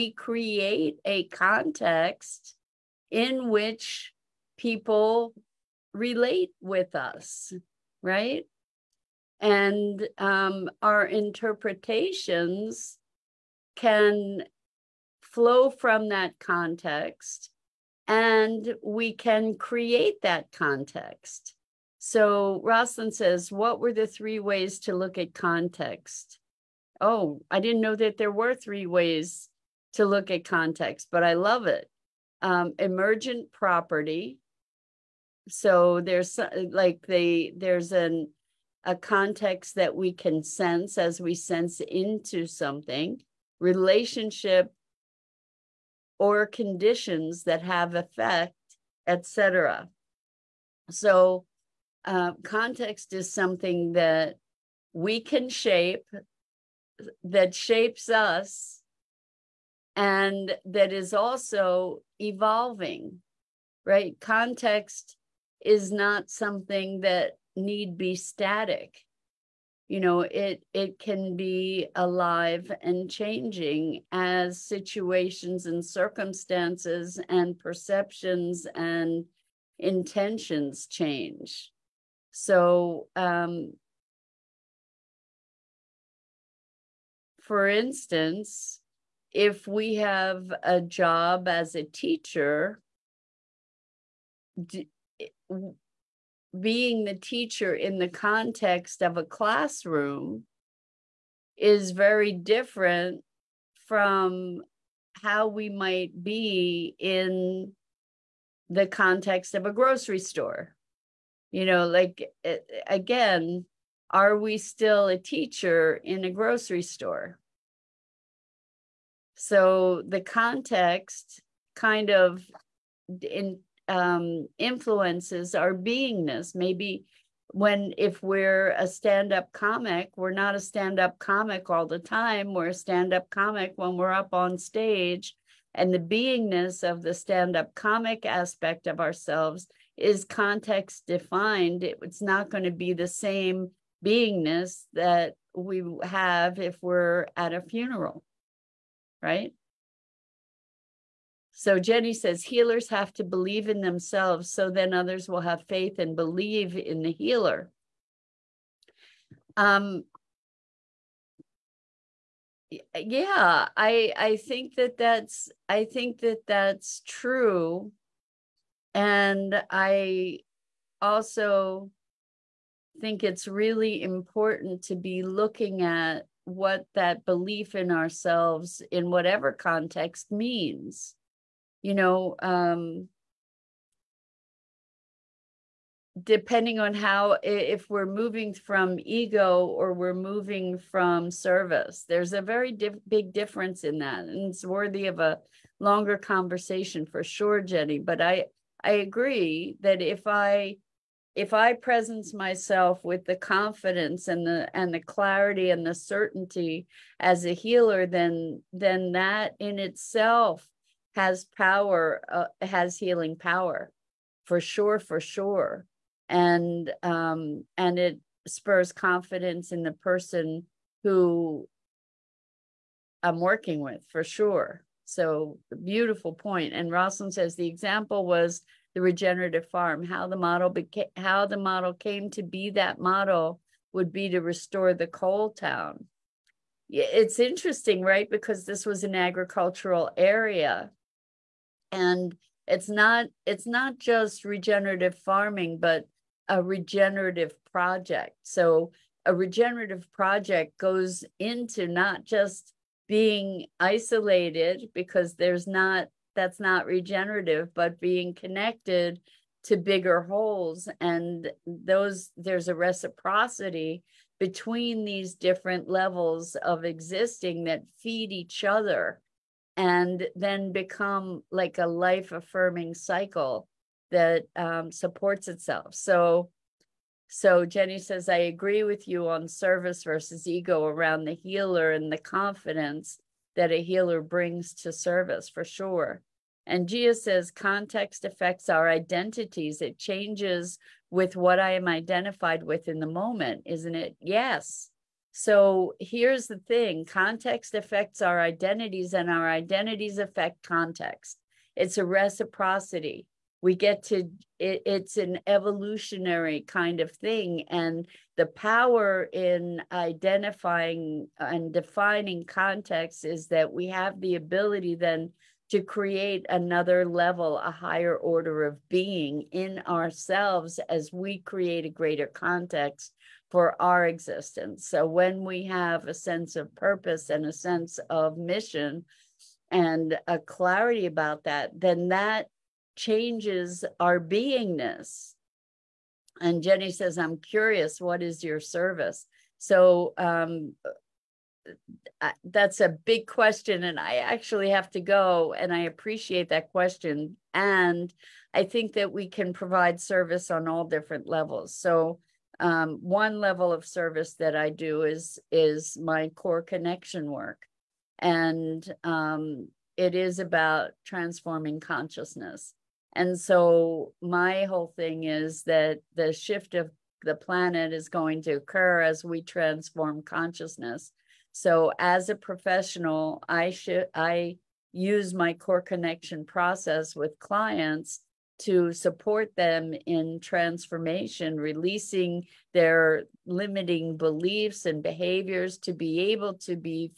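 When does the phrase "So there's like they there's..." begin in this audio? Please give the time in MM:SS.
00:35.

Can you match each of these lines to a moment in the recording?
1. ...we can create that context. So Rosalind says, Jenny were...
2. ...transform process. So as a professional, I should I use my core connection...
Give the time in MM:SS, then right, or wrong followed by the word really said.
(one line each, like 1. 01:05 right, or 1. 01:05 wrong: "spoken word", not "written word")
1. 00:18 wrong: "What", not "Jenny"
2. 06:09 wrong: "consciousness", not "process".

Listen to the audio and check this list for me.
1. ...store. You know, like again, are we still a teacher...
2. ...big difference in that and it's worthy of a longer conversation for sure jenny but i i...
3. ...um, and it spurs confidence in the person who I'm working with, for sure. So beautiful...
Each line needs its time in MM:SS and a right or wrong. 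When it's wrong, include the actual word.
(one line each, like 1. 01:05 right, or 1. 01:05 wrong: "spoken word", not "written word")
1. 01:50 right
2. 03:13 right
3. 03:37 right.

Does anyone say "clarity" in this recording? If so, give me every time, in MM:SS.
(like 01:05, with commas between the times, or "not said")
03:25, 05:30.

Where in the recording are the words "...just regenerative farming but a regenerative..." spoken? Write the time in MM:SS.
04:03.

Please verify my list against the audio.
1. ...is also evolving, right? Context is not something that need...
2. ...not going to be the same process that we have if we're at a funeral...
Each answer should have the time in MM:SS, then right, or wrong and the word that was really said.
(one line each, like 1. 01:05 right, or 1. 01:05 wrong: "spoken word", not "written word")
1. 01:00 right
2. 02:22 wrong: "beingness", not "process".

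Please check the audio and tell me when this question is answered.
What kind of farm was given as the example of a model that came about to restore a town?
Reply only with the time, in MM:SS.
03:49.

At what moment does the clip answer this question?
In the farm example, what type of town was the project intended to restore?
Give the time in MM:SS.
03:55.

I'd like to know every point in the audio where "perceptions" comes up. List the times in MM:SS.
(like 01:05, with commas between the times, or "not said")
01:17.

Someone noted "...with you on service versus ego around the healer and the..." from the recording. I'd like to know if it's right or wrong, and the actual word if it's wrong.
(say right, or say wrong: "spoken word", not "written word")
right.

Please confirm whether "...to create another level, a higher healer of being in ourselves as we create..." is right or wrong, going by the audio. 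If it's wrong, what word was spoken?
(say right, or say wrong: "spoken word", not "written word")
wrong: "order", not "healer".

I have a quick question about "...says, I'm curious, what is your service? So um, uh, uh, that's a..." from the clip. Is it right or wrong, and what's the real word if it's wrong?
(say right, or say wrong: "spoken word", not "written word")
right.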